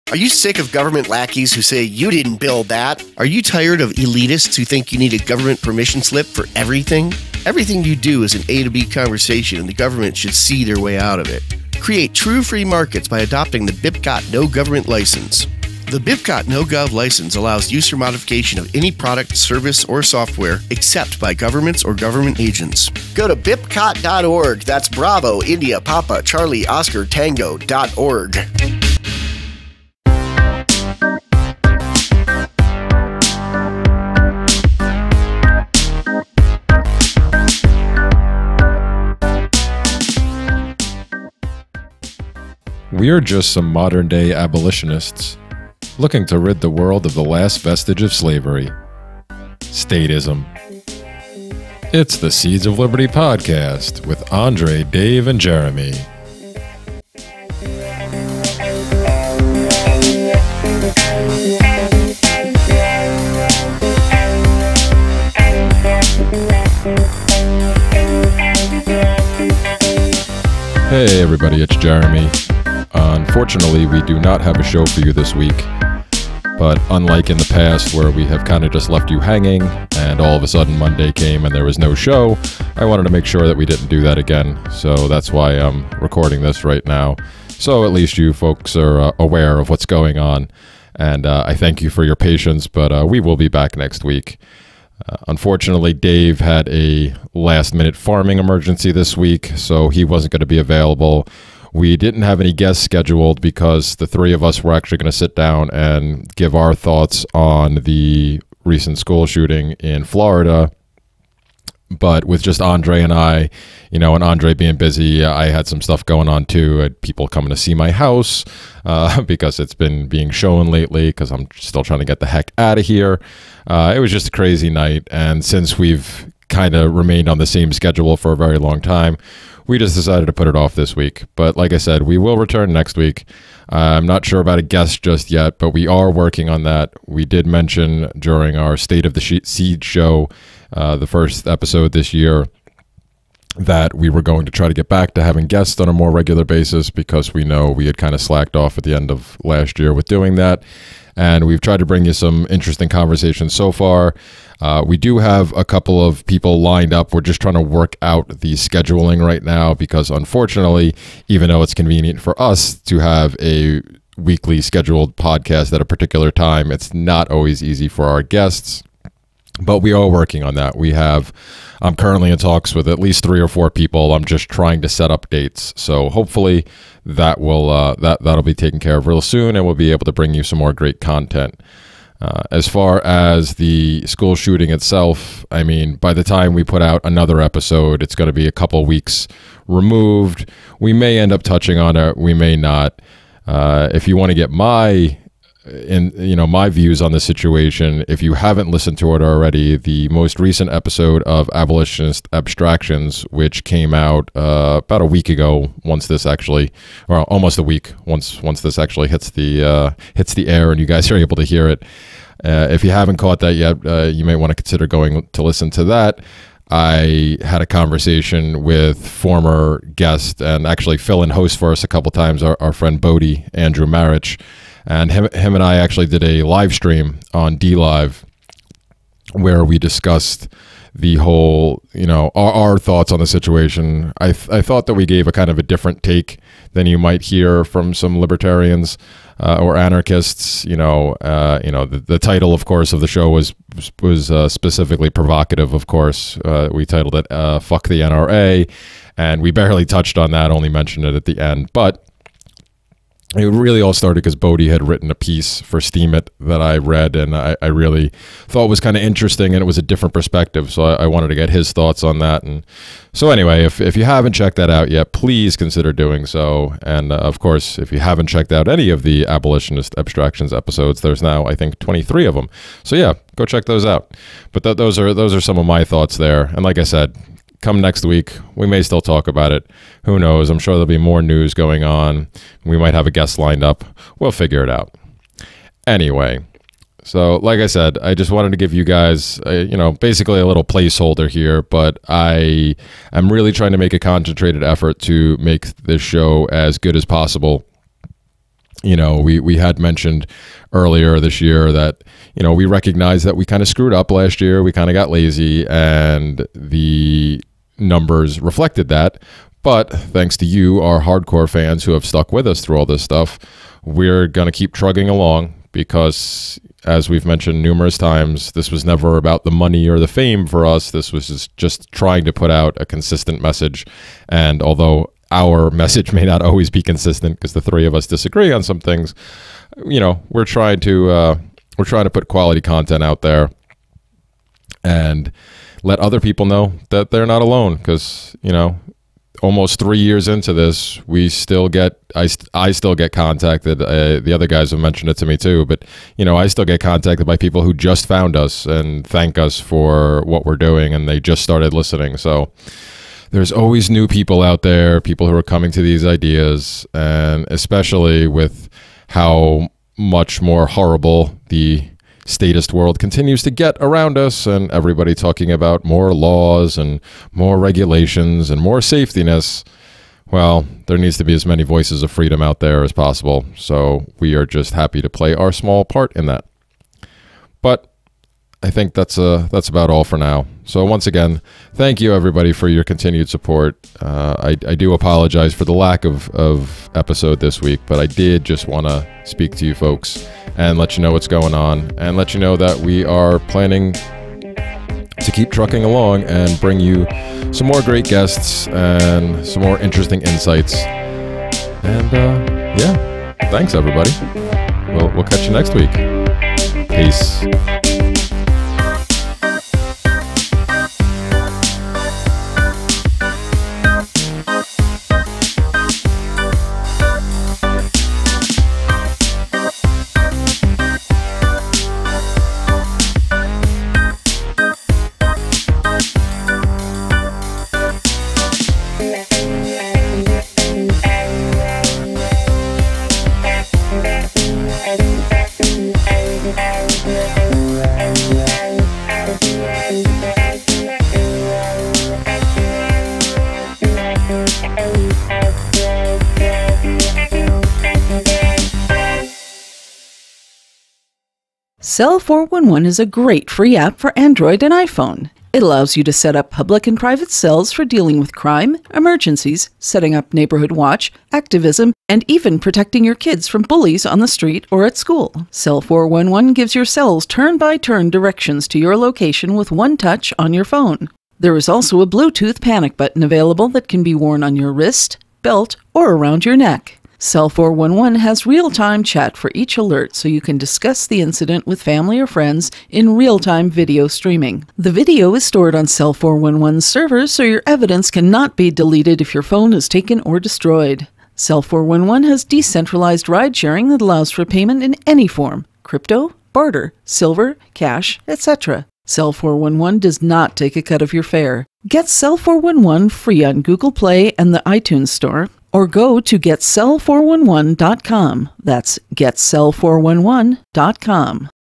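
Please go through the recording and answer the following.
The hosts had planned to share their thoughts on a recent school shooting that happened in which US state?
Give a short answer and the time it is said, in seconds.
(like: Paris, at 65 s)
Florida, at 110 s.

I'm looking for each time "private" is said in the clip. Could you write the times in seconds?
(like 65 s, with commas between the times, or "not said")
456 s.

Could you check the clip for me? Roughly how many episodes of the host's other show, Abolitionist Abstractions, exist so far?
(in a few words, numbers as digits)
23.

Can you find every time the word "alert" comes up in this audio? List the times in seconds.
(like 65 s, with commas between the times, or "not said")
479 s.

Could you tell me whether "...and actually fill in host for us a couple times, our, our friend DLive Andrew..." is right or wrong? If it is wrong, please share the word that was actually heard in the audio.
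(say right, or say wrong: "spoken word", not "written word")
wrong: "Bodie", not "DLive".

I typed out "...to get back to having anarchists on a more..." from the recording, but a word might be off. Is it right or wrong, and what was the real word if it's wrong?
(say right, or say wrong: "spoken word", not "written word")
wrong: "guests", not "anarchists".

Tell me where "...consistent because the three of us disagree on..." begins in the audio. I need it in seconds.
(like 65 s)
326 s.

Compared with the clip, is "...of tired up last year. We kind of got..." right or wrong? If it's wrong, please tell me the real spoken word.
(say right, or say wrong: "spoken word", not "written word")
wrong: "screwed", not "tired".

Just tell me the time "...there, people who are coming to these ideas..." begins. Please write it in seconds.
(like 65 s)
354 s.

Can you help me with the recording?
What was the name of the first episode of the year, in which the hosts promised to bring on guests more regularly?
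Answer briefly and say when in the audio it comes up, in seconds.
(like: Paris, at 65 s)
State of the Seed, at 138 s.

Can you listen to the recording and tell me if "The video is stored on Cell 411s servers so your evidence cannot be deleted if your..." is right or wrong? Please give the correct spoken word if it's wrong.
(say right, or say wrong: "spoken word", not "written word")
right.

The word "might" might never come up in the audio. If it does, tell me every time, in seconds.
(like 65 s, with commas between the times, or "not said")
236 s, 282 s.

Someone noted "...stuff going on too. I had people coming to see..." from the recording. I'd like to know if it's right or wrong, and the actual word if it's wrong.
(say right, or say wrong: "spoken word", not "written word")
right.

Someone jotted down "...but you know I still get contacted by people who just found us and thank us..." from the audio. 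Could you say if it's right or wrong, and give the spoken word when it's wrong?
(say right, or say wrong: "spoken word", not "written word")
right.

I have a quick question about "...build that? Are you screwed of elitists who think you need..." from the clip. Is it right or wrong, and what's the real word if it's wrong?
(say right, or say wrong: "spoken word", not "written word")
wrong: "tired", not "screwed".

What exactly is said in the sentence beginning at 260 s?
So I, I, wanted to get his thoughts on that.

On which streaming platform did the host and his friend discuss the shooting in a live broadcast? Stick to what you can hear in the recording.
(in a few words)
DLive.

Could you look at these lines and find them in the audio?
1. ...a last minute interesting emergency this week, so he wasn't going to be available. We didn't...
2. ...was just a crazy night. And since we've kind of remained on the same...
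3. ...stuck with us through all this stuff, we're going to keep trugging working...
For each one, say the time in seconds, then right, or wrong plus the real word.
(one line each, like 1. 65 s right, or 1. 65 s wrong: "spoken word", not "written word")
1. 96 s wrong: "farming", not "interesting"
2. 123 s right
3. 312 s wrong: "along", not "working".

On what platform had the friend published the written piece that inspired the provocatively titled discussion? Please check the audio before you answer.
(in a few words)
Steemit.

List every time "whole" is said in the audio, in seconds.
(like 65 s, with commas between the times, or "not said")
231 s.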